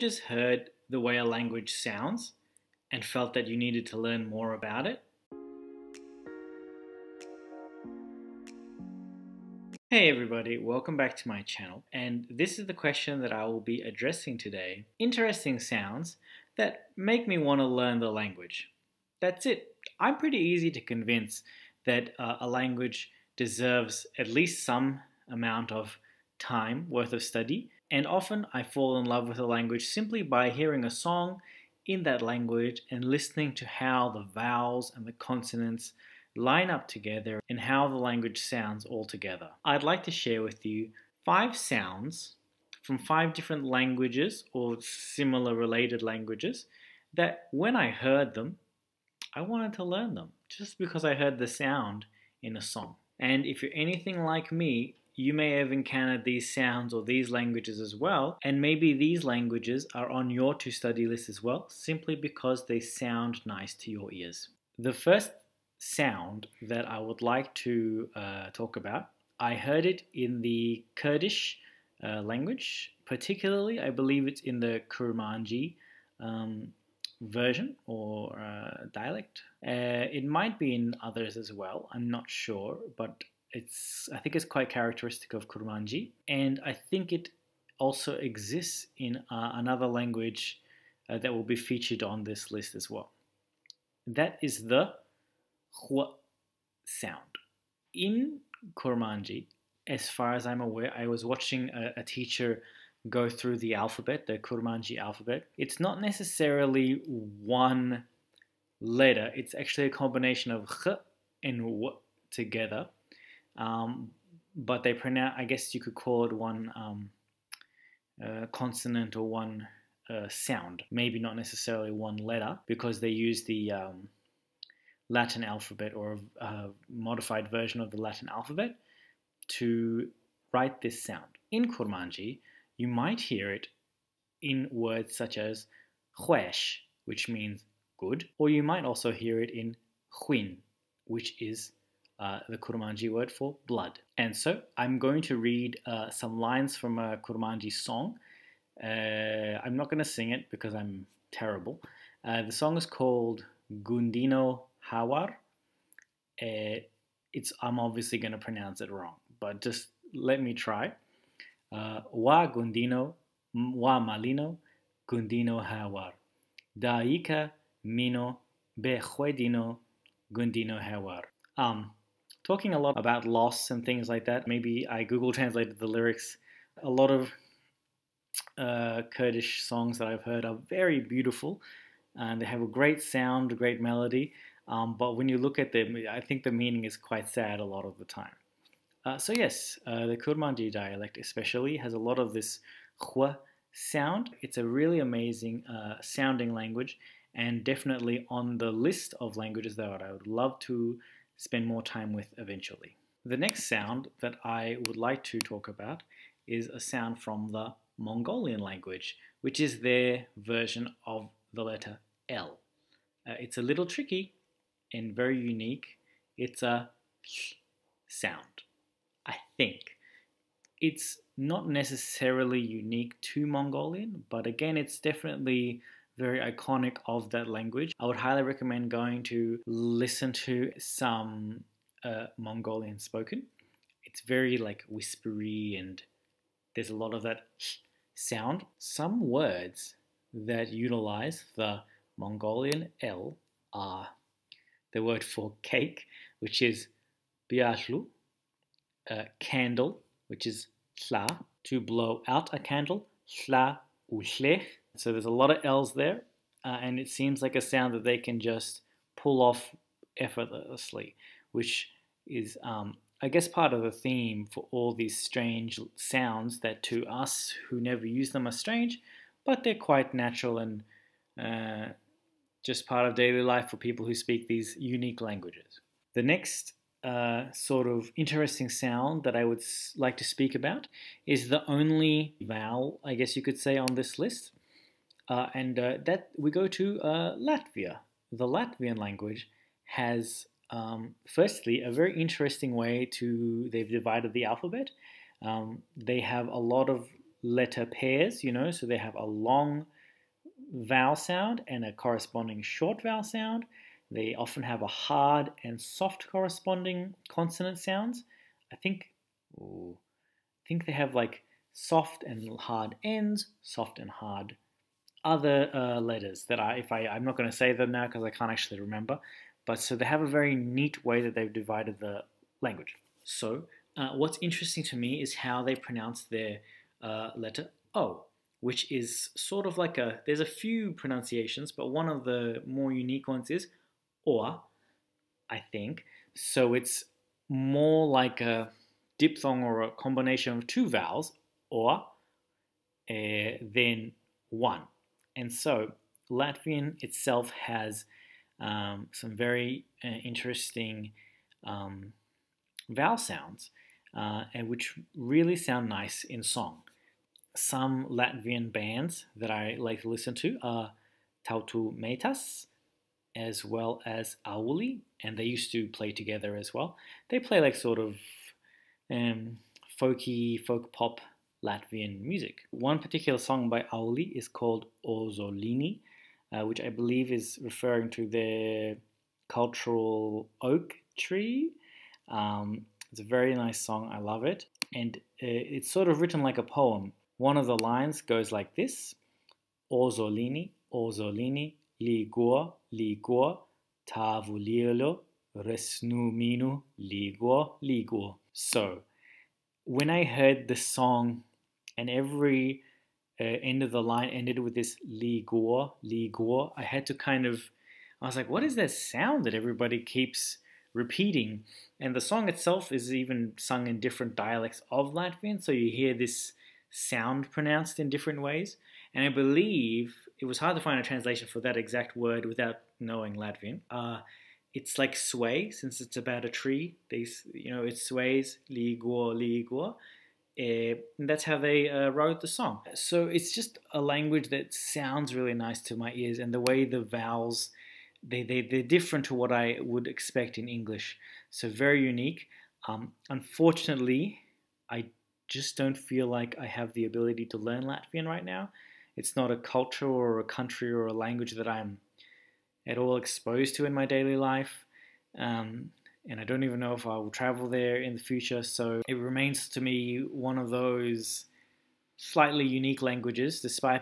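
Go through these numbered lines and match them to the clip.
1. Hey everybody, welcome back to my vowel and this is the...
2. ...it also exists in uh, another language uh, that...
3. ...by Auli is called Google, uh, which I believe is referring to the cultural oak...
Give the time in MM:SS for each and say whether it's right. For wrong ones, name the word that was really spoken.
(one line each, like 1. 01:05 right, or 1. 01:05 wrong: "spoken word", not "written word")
1. 00:09 wrong: "channel", not "vowel"
2. 01:27 right
3. 06:13 wrong: "Ozolini", not "Google".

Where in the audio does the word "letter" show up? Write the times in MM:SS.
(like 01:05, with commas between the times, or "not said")
01:48, 02:02, 03:31, 04:57, 05:15, 05:27.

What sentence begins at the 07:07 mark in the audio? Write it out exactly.
These, you know, it sways ligor, ligor.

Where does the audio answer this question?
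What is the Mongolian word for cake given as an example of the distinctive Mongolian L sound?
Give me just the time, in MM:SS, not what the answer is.
04:07.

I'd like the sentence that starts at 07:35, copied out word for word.
Um, and I don't even know if I will travel there in the future.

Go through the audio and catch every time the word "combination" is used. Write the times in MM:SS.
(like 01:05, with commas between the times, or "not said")
01:49, 05:39.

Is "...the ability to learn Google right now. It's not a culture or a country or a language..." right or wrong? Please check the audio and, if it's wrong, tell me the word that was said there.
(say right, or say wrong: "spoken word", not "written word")
wrong: "Latvian", not "Google".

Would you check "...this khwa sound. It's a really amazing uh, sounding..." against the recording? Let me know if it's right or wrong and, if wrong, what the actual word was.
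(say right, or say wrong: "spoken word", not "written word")
right.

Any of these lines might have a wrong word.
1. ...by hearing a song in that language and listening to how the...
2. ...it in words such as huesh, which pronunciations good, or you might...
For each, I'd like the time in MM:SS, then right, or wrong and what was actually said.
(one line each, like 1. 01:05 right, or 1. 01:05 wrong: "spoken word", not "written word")
1. 00:30 right
2. 02:13 wrong: "means", not "pronunciations".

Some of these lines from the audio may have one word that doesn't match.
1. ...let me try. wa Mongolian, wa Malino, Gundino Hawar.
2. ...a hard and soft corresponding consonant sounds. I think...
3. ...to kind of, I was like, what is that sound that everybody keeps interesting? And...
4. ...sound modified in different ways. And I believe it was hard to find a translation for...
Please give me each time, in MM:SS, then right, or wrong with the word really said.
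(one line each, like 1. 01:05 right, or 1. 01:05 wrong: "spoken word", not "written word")
1. 02:40 wrong: "Gundino", not "Mongolian"
2. 05:04 right
3. 06:47 wrong: "repeating", not "interesting"
4. 06:56 wrong: "pronounced", not "modified".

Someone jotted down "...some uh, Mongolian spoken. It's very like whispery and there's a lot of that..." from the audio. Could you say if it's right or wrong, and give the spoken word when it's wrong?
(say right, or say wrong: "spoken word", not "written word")
right.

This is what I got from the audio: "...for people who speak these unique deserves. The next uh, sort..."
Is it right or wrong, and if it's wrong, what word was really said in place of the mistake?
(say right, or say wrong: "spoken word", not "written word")
wrong: "languages", not "deserves".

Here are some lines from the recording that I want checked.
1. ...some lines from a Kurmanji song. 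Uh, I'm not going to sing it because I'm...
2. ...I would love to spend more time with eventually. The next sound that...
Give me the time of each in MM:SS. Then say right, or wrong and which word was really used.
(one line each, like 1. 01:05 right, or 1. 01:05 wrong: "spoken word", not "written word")
1. 02:26 right
2. 03:20 right.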